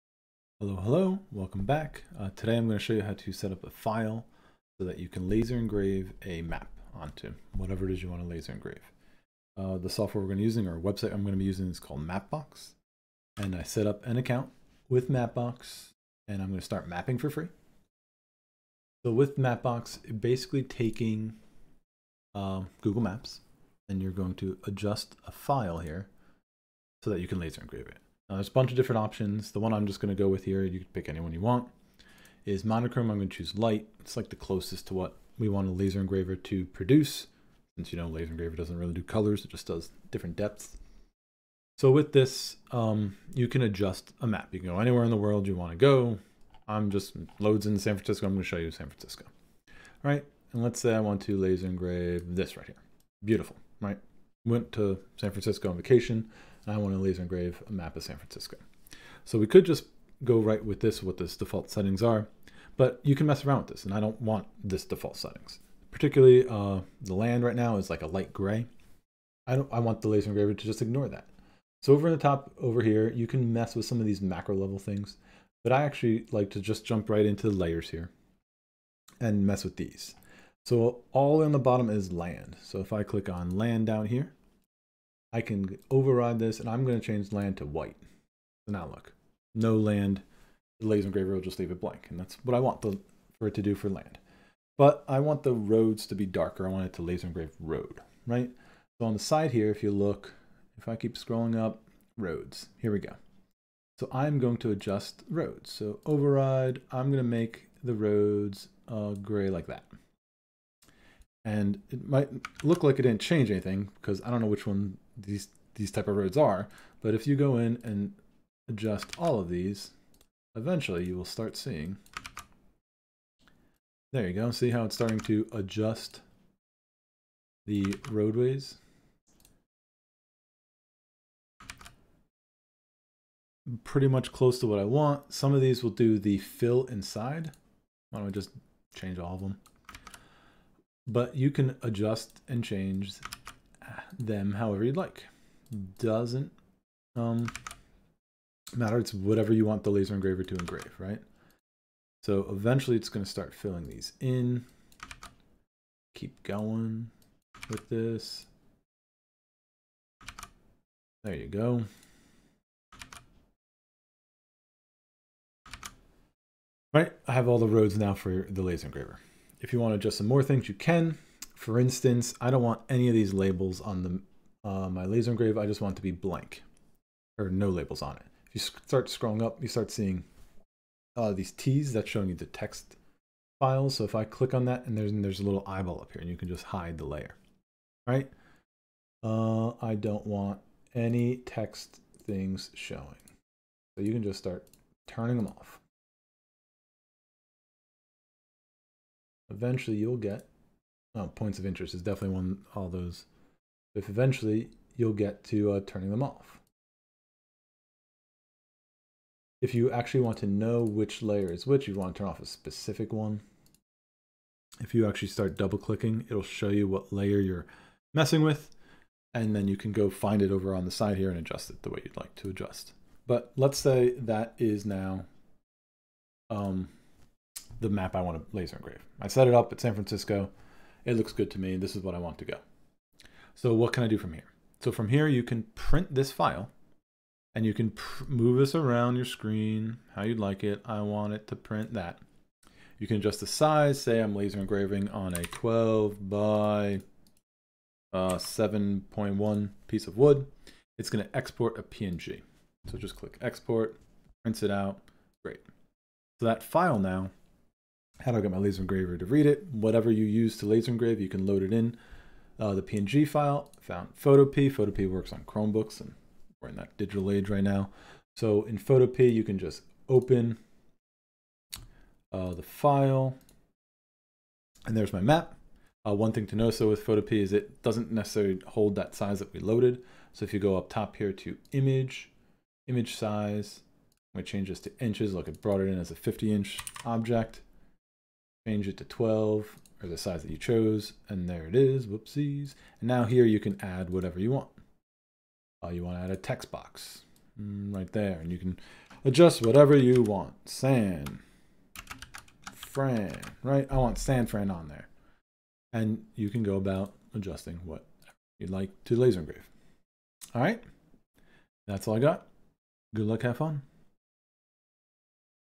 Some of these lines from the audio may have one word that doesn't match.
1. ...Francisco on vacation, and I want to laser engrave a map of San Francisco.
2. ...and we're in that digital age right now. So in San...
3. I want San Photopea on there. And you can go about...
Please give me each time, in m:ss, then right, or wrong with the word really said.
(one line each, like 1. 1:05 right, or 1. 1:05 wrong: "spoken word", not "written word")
1. 0:55 right
2. 4:25 wrong: "Photopea", not "San"
3. 5:03 wrong: "Fran", not "Photopea".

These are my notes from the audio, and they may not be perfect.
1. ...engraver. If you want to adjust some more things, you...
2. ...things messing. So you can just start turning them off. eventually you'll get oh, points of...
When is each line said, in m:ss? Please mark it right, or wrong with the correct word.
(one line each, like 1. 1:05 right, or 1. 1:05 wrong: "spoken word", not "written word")
1. 2:48 right
2. 3:12 wrong: "showing", not "messing".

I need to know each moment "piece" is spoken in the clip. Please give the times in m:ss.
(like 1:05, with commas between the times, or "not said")
4:09.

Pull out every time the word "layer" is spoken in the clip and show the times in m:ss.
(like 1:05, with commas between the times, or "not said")
1:17, 3:07, 3:31, 3:37.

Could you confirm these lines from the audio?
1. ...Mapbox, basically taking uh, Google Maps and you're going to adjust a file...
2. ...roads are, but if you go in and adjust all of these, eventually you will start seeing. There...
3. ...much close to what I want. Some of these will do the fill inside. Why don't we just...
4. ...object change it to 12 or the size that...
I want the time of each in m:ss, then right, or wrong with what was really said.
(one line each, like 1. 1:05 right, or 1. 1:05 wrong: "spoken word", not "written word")
1. 0:19 right
2. 1:56 right
3. 2:14 right
4. 4:47 right.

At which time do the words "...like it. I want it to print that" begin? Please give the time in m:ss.
4:00.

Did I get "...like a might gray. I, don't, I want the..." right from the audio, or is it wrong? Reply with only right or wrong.
wrong.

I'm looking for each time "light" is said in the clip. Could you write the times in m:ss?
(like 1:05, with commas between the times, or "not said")
0:33, 1:08.